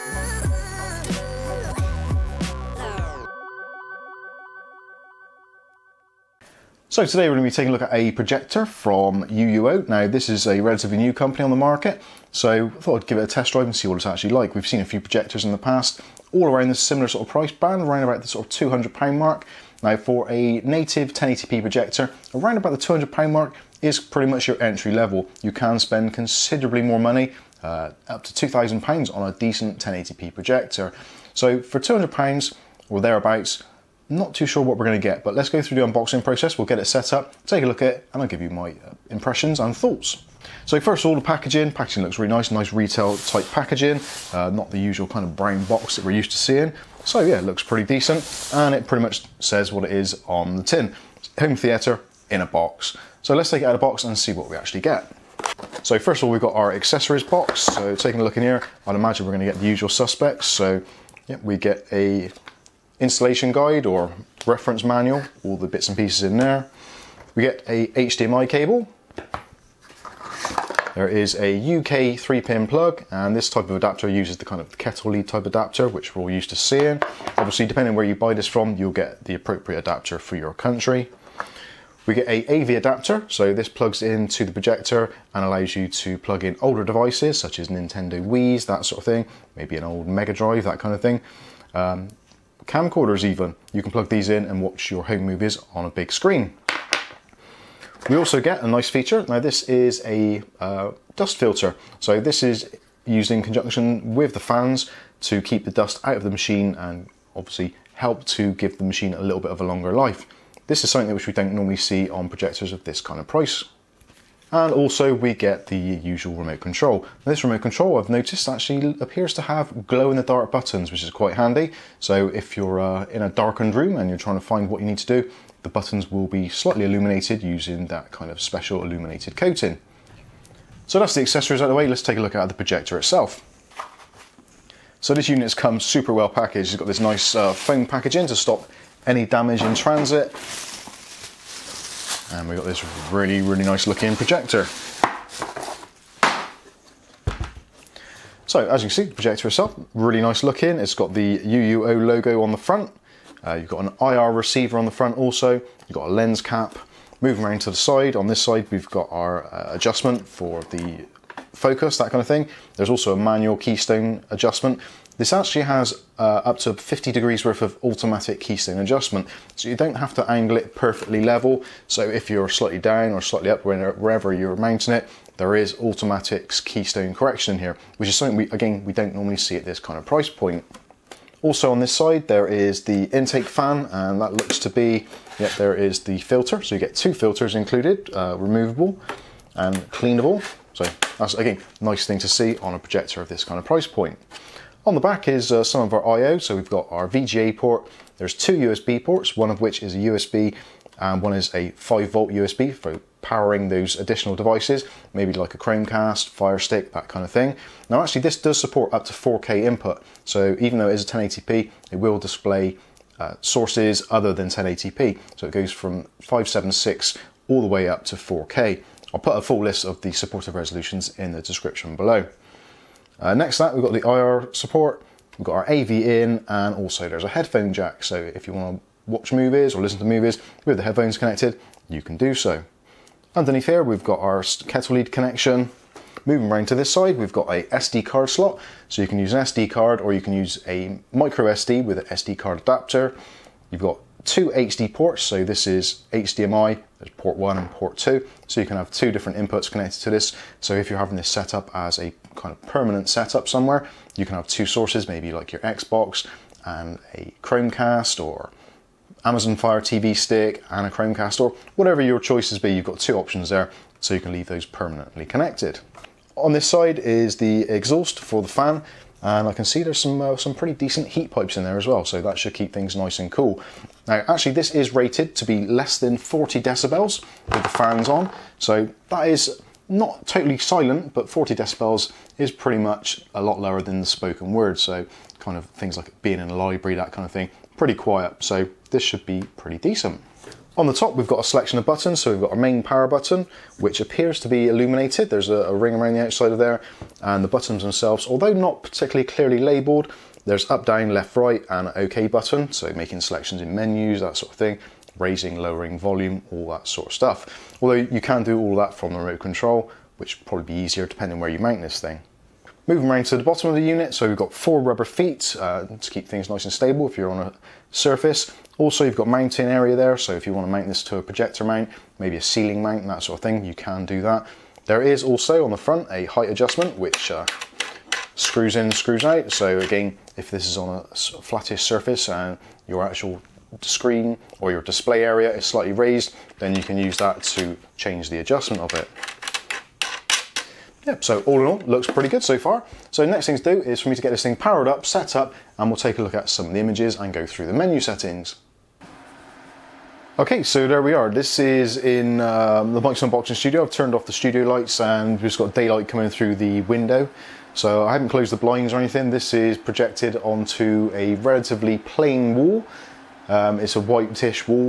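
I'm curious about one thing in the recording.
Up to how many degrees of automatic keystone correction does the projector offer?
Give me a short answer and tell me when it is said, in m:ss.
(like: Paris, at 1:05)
50 degrees, at 2:46.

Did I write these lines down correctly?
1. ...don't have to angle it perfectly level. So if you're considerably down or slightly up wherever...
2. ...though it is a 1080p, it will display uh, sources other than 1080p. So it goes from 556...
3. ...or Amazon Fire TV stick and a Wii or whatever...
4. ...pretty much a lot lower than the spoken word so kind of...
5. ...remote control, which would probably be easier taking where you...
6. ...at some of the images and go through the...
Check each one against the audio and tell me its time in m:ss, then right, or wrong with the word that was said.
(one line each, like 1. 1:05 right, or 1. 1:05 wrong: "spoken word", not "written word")
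1. 2:49 wrong: "slightly", not "considerably"
2. 3:30 wrong: "576", not "556"
3. 4:18 wrong: "Chromecast", not "Wii"
4. 4:42 right
5. 5:09 wrong: "depending", not "taking"
6. 5:46 right.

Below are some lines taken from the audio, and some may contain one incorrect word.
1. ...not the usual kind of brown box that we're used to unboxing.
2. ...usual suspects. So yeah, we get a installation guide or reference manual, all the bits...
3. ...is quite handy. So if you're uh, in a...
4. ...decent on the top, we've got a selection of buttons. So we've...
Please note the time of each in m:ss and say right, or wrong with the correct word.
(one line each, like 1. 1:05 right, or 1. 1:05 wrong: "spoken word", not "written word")
1. 0:44 wrong: "seeing", not "unboxing"
2. 0:59 right
3. 2:01 right
4. 4:49 right.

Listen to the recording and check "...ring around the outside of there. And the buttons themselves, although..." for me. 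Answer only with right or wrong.
right.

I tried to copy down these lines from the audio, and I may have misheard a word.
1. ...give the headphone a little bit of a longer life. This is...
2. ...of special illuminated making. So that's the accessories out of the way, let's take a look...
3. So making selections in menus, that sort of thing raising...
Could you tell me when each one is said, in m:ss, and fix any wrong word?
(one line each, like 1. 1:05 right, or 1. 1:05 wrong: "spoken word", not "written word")
1. 1:48 wrong: "machine", not "headphone"
2. 2:08 wrong: "coating", not "making"
3. 5:02 right.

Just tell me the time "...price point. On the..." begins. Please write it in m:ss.
3:13.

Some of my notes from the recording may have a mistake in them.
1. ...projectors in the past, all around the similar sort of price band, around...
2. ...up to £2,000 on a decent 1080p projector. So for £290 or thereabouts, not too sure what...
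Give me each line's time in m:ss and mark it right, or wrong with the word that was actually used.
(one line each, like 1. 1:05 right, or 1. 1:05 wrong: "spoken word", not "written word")
1. 0:14 right
2. 0:28 wrong: "200", not "290".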